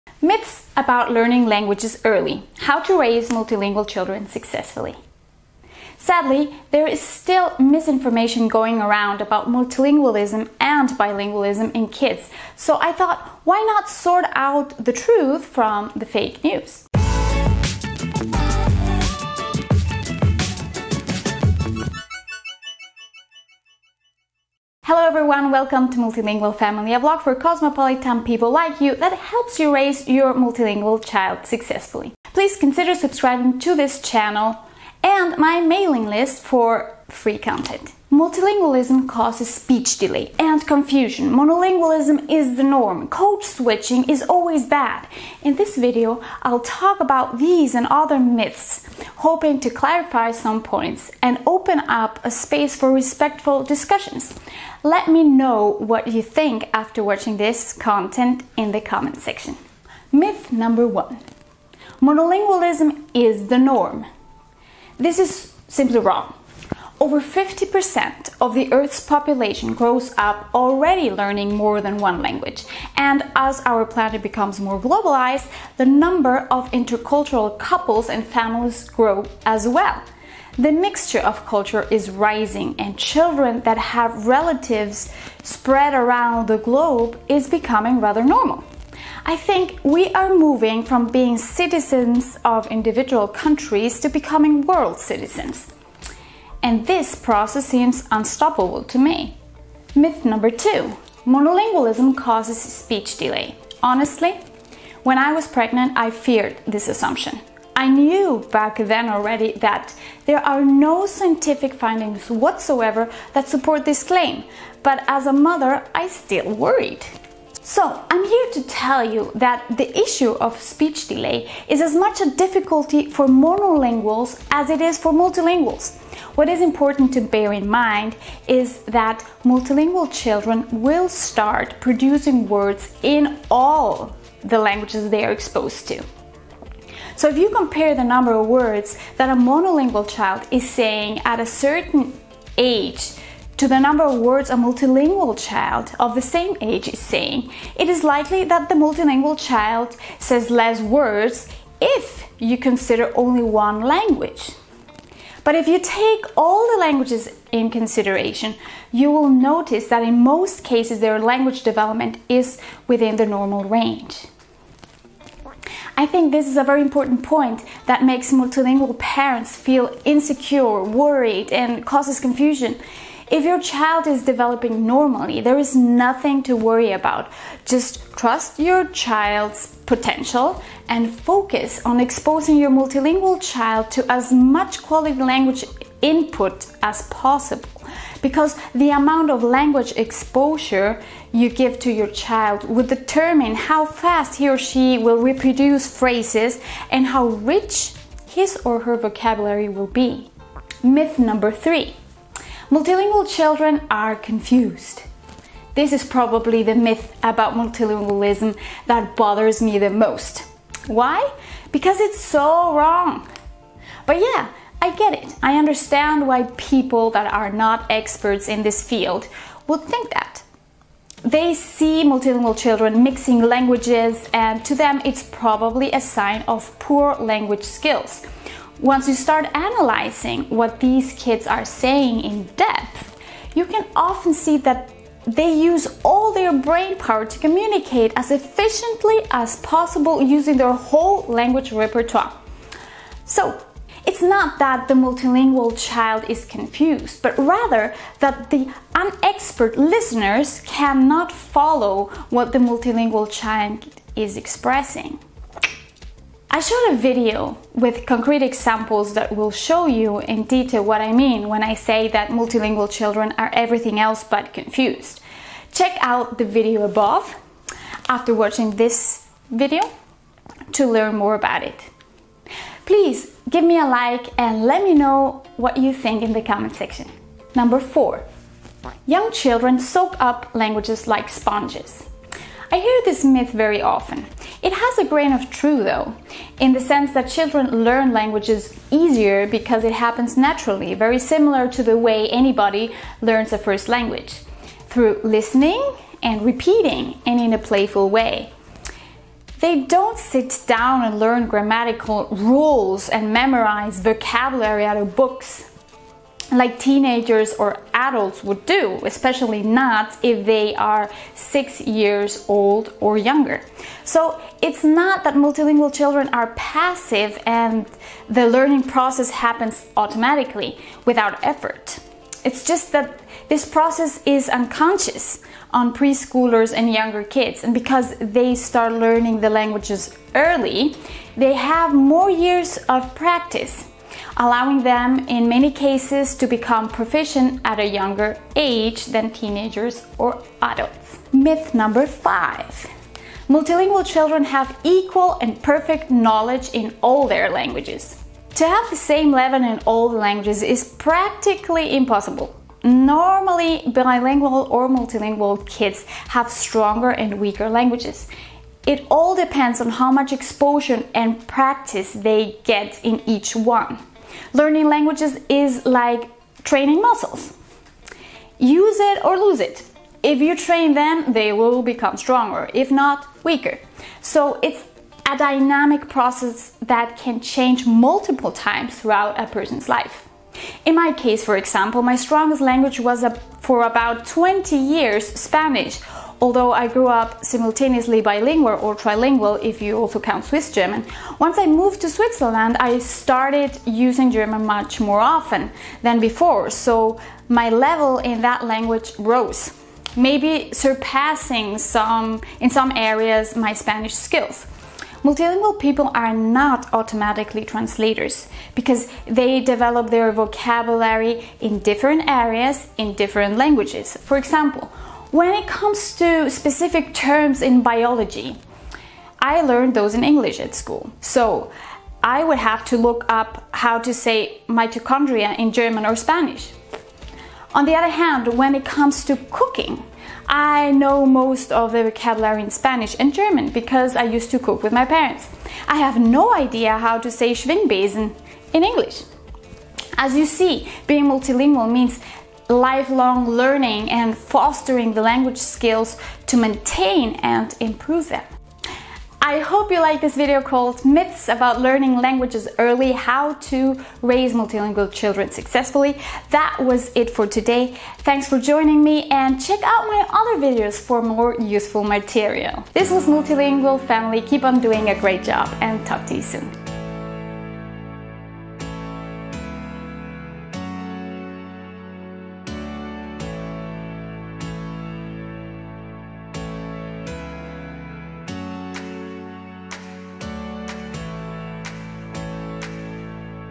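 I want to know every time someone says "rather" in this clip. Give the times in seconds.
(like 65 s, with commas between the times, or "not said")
87 s, 247 s.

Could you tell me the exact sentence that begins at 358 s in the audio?
It all depends on how much exposure and practice they get in each one.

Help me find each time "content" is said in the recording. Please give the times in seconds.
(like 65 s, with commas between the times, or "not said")
37 s, 57 s.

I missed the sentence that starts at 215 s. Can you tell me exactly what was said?
I understand why people that are not experts in this field would think that.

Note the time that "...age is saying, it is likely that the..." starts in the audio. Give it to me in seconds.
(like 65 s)
146 s.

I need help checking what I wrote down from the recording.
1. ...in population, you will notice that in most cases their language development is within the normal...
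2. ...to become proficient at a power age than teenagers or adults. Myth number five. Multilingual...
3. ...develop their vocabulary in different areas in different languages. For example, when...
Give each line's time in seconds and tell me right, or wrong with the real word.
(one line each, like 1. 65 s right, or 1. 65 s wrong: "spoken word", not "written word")
1. 157 s wrong: "consideration", not "population"
2. 336 s wrong: "younger", not "power"
3. 409 s right.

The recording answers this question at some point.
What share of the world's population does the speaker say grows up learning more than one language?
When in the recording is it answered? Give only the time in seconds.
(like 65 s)
67 s.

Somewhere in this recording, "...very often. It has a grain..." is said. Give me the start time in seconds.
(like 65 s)
283 s.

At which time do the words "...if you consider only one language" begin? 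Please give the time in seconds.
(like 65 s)
151 s.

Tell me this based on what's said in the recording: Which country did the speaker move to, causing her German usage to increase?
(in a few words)
Switzerland.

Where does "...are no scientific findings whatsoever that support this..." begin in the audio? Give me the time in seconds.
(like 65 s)
110 s.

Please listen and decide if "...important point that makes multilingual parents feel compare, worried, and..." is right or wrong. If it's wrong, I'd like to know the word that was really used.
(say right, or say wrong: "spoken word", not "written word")
wrong: "insecure", not "compare".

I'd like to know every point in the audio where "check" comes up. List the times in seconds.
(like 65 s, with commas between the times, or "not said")
265 s, 459 s.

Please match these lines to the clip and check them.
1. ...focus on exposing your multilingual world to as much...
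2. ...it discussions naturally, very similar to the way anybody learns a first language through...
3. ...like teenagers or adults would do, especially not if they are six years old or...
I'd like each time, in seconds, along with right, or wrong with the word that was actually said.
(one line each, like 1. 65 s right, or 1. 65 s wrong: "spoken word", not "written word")
1. 181 s wrong: "child", not "world"
2. 289 s wrong: "happens", not "discussions"
3. 306 s right.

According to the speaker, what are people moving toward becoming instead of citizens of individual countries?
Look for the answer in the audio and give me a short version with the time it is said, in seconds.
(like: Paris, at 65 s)
World citizens, at 94 s.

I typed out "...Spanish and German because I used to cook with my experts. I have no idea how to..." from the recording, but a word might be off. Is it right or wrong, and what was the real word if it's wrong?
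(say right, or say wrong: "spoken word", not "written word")
wrong: "parents", not "experts".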